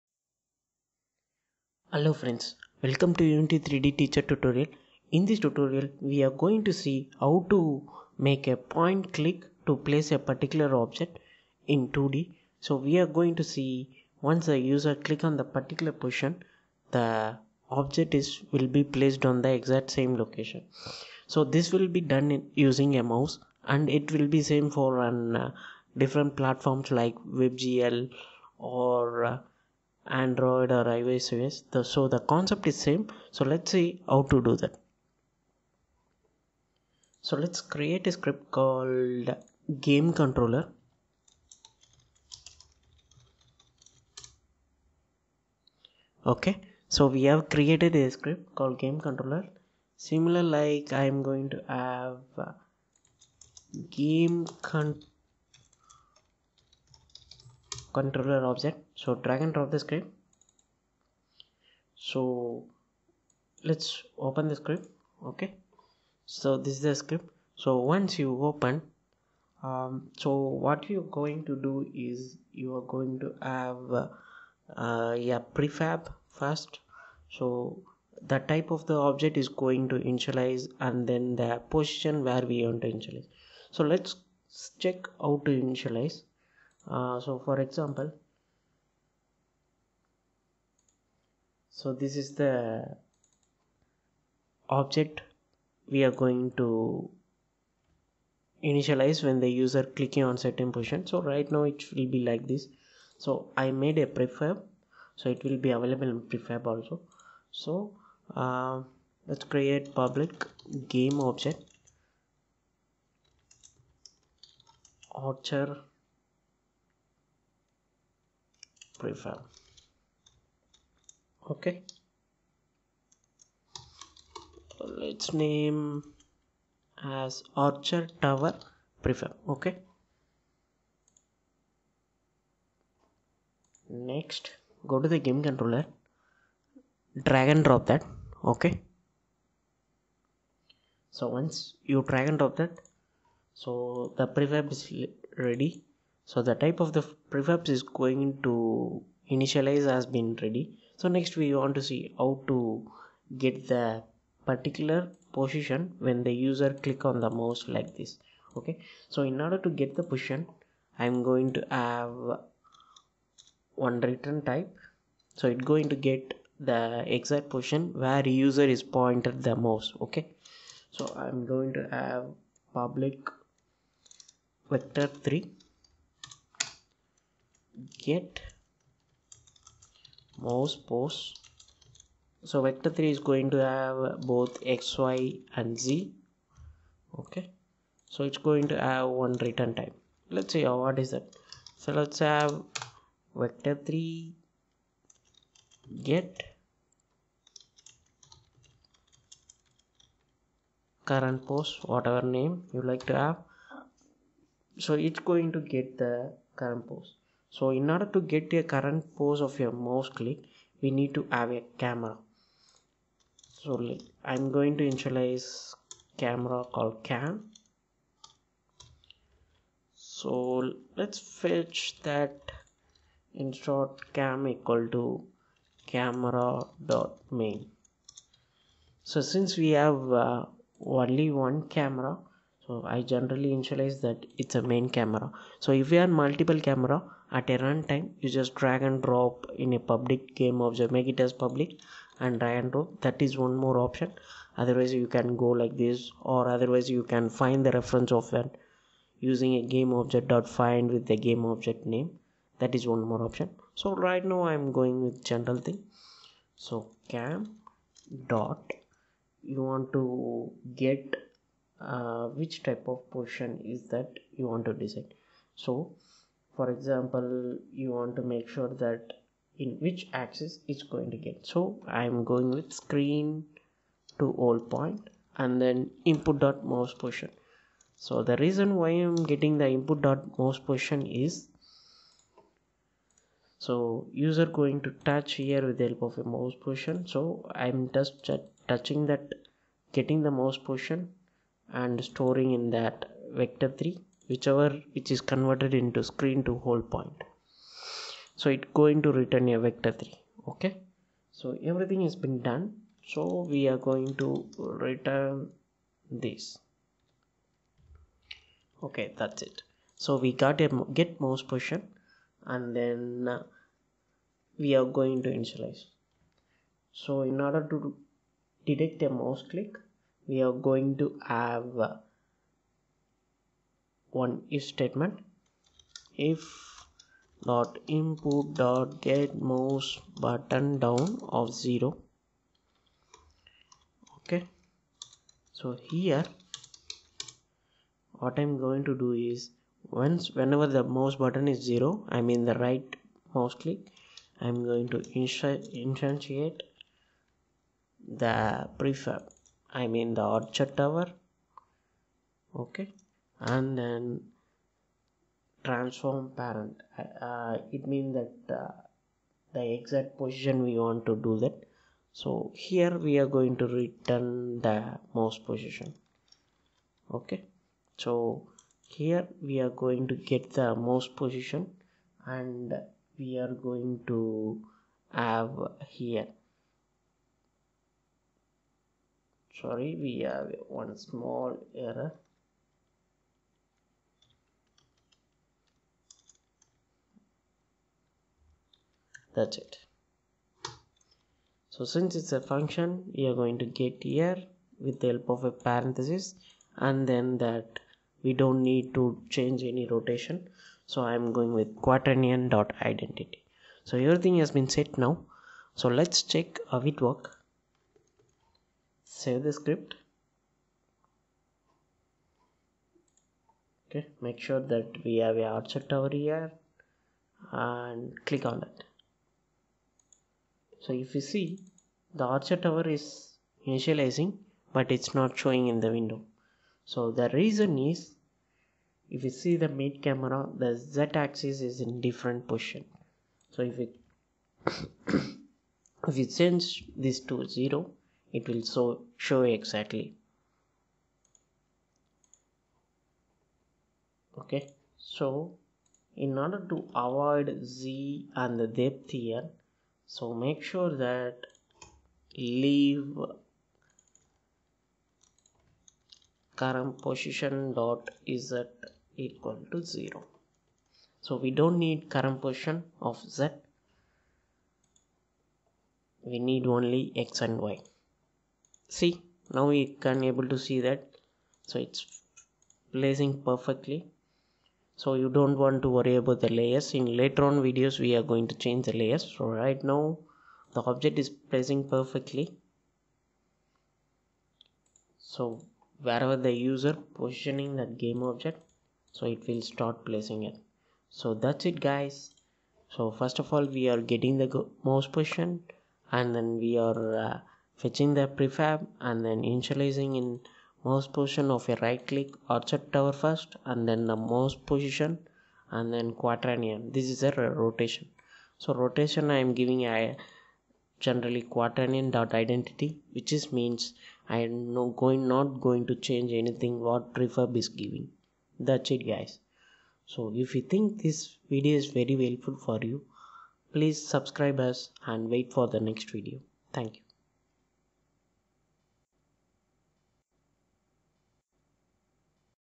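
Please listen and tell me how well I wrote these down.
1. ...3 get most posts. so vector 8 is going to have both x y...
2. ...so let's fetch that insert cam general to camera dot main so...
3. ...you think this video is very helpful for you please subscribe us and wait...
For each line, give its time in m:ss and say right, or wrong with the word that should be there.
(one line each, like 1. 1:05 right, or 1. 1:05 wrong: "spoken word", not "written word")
1. 2:55 wrong: "3", not "8"
2. 3:40 wrong: "equal", not "general"
3. 8:40 right.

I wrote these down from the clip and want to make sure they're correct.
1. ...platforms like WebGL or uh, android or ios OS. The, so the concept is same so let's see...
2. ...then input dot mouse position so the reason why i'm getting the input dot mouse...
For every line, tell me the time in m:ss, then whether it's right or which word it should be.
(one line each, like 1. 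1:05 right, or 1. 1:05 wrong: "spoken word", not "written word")
1. 0:26 right
2. 4:35 right.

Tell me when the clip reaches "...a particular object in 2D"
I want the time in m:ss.
0:10.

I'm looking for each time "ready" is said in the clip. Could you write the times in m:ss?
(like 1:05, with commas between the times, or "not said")
2:25, 2:30.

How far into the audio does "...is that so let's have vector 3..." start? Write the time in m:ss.
3:11.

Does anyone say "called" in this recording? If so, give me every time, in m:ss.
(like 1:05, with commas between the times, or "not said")
0:38, 0:48, 3:36.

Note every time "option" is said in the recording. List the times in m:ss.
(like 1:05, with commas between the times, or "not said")
4:03, 4:13.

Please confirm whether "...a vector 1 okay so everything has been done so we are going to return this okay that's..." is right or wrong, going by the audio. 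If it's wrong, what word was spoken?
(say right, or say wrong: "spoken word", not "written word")
wrong: "3", not "1".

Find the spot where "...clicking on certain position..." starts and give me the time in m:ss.
1:39.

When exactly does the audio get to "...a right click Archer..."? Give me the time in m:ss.
8:21.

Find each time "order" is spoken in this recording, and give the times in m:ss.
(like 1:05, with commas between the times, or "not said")
2:39, 3:27, 5:17, 7:26.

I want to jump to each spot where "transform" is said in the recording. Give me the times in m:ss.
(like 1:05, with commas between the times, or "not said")
5:55.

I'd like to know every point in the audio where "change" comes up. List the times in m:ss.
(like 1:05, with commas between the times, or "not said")
6:39, 7:16, 7:58, 8:36.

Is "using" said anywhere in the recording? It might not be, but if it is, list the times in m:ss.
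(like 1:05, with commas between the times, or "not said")
0:22, 4:09.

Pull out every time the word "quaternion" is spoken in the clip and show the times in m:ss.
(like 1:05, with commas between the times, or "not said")
6:41, 8:26, 8:31.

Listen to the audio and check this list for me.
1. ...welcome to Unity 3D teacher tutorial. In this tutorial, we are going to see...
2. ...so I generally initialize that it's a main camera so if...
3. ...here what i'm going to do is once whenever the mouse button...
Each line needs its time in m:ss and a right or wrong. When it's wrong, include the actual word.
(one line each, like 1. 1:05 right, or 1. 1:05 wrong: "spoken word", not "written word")
1. 0:02 right
2. 3:52 right
3. 5:35 right.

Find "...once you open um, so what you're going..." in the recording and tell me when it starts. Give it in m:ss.
1:07.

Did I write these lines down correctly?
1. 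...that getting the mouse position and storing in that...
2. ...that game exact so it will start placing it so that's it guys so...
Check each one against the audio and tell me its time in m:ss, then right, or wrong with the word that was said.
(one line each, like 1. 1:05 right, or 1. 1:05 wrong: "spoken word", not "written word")
1. 4:49 right
2. 8:07 wrong: "object", not "exact".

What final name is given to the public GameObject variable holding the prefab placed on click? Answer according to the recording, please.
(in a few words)
Archer Tower prefab.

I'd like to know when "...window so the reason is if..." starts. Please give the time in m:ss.
7:05.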